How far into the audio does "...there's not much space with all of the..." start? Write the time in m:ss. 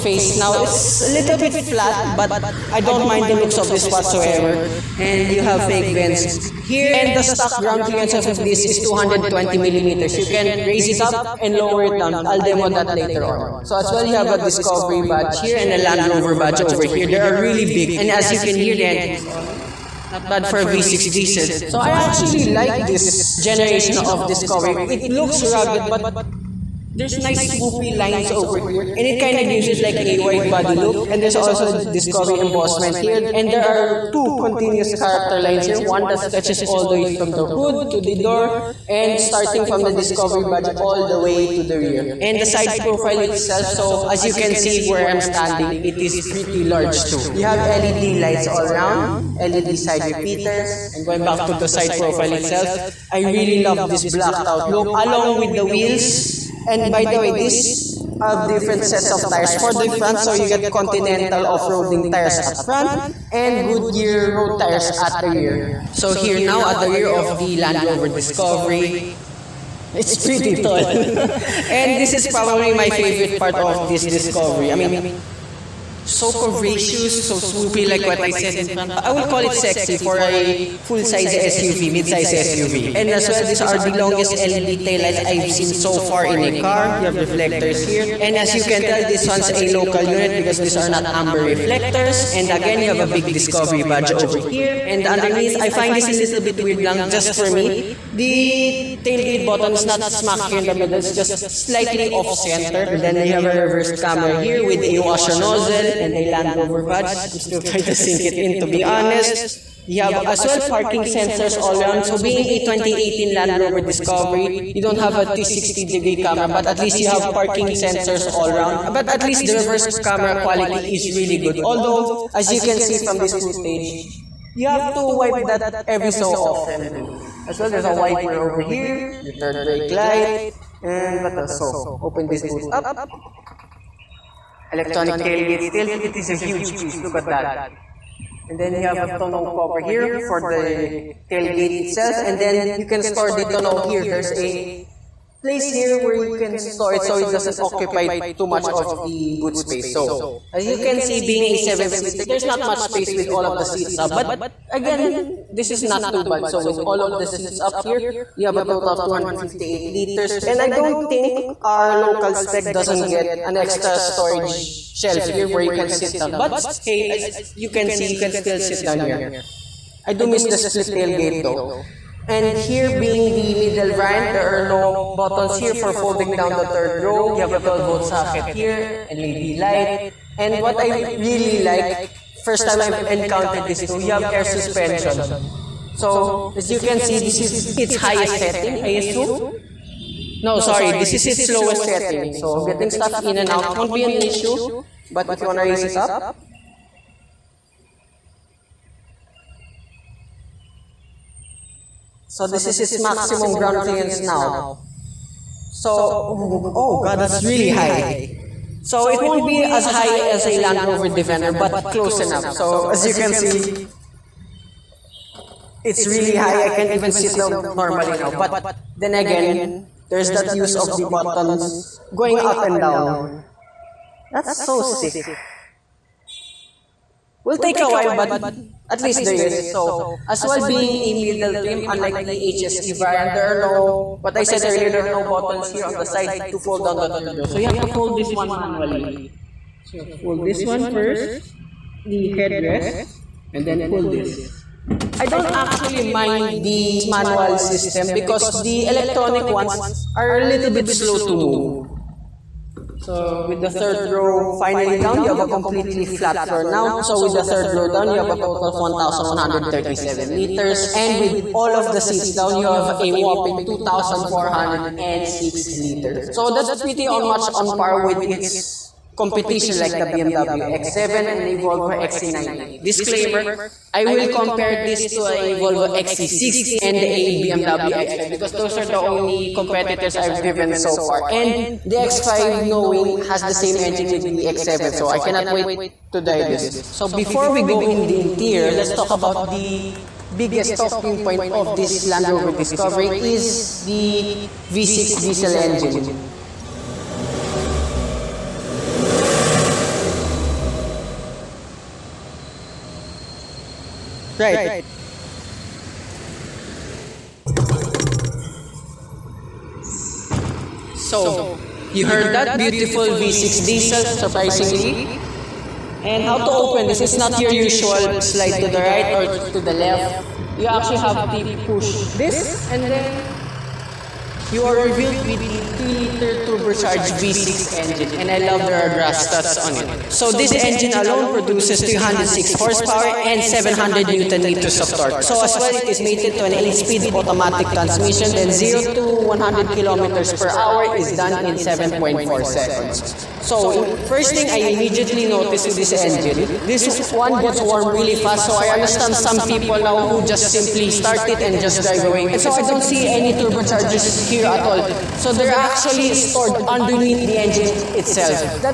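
2:32.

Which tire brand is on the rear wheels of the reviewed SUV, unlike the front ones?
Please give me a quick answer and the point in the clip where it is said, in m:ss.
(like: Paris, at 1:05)
Goodyear, at 1:03.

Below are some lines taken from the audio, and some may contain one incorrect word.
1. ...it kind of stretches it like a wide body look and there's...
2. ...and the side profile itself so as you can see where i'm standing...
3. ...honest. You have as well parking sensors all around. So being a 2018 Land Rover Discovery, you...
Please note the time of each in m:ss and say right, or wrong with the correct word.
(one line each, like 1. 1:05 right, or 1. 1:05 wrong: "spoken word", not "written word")
1. 0:29 wrong: "gives", not "stretches"
2. 0:42 right
3. 1:48 right.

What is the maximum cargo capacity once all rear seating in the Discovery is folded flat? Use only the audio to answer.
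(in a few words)
2,406 liters.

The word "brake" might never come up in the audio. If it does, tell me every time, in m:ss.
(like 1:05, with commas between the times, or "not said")
2:09.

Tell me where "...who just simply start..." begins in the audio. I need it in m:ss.
5:50.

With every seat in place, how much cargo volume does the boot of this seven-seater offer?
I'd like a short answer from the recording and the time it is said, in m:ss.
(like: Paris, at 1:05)
258 liters, at 2:39.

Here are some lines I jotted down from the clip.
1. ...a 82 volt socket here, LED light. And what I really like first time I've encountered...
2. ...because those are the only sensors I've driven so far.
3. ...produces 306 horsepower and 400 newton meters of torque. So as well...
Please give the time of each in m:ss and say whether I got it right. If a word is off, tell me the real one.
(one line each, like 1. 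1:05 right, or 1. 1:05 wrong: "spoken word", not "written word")
1. 2:57 wrong: "12", not "82"
2. 4:38 wrong: "competitors", not "sensors"
3. 5:31 wrong: "700", not "400".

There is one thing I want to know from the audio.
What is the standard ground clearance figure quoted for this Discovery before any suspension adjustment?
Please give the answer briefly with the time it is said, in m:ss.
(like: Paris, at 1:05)
220 millimeters, at 0:08.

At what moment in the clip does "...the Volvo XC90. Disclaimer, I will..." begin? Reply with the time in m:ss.
4:31.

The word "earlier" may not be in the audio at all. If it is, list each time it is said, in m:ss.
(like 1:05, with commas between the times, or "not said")
3:54.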